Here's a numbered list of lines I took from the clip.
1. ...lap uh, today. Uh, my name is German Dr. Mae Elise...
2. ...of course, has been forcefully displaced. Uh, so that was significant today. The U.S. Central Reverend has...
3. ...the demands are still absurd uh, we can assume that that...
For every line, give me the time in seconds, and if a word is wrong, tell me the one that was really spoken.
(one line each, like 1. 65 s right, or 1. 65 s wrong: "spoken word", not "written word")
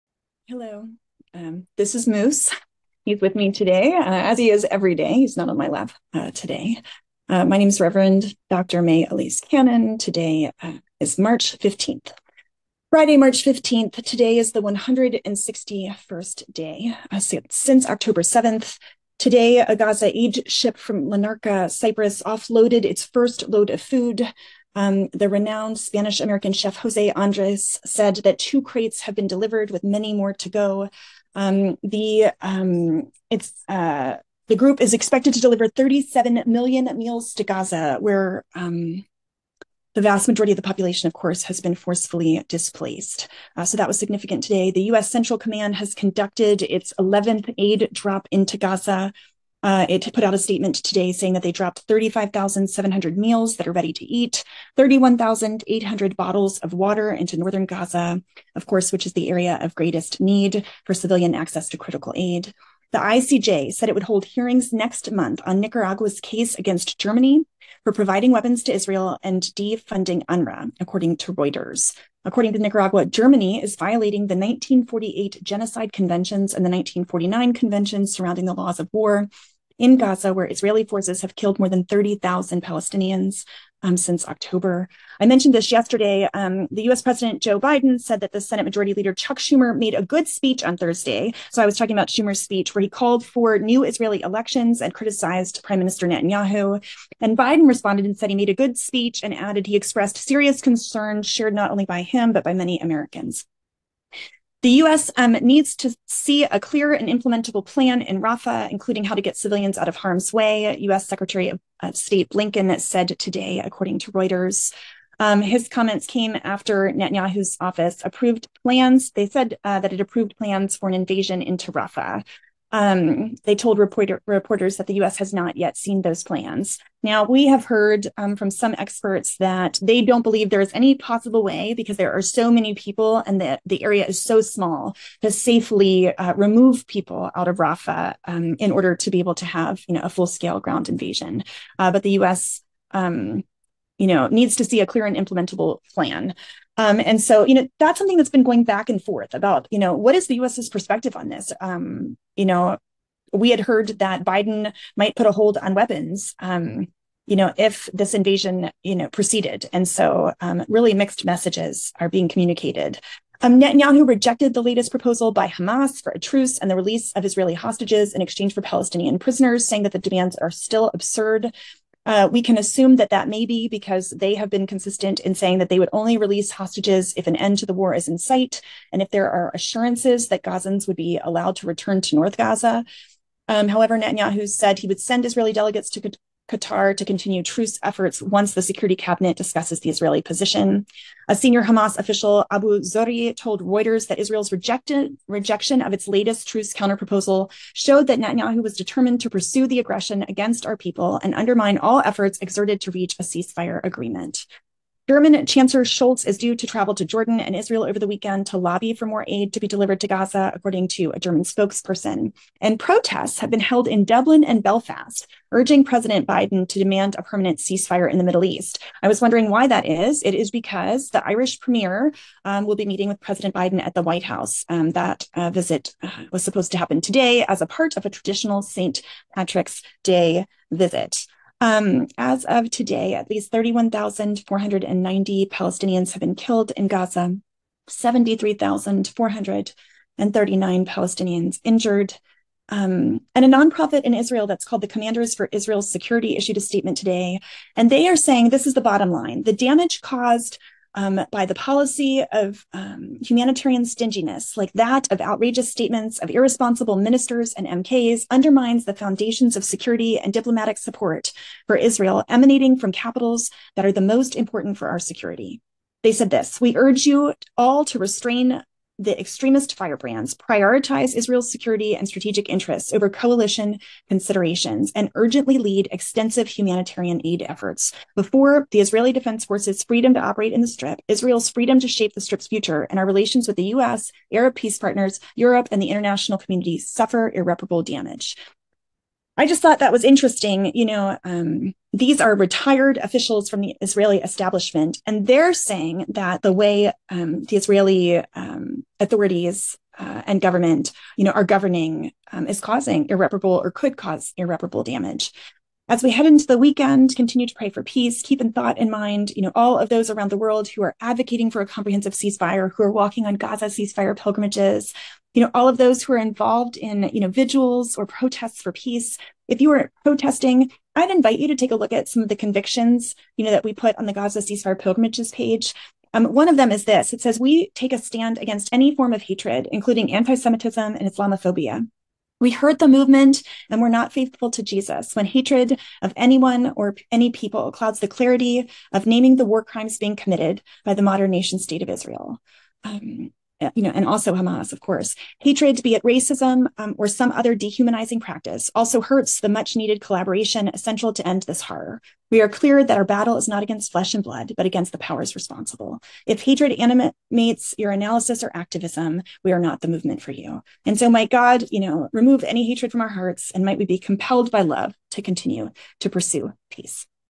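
1. 5 s wrong: "Reverend", not "German"
2. 41 s wrong: "Command", not "Reverend"
3. 169 s right.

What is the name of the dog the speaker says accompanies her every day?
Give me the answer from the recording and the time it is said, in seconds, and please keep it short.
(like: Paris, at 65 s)
Moose, at 2 s.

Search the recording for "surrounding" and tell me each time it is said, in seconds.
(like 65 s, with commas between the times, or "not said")
78 s.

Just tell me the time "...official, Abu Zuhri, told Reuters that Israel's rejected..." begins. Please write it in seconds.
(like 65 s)
191 s.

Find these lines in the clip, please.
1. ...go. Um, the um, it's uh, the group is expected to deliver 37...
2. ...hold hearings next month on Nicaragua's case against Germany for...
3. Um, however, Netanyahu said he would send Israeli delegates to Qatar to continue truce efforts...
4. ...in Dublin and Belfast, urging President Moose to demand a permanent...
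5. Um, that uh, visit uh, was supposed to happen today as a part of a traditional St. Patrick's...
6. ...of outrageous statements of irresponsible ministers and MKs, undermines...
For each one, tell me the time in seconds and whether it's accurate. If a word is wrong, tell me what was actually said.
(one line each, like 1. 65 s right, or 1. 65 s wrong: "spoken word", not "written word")
1. 30 s right
2. 64 s right
3. 183 s right
4. 213 s wrong: "Biden", not "Moose"
5. 224 s right
6. 255 s right.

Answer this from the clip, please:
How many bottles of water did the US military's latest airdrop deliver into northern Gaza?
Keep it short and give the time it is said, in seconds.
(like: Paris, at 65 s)
31,800, at 54 s.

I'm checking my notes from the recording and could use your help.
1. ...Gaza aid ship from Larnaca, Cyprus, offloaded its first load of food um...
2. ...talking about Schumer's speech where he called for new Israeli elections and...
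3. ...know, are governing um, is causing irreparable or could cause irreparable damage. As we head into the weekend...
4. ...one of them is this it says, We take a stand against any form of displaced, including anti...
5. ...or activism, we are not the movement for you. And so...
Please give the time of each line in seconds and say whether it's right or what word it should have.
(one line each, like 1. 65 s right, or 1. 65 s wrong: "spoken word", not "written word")
1. 19 s right
2. 91 s right
3. 301 s right
4. 326 s wrong: "hatred", not "displaced"
5. 358 s right.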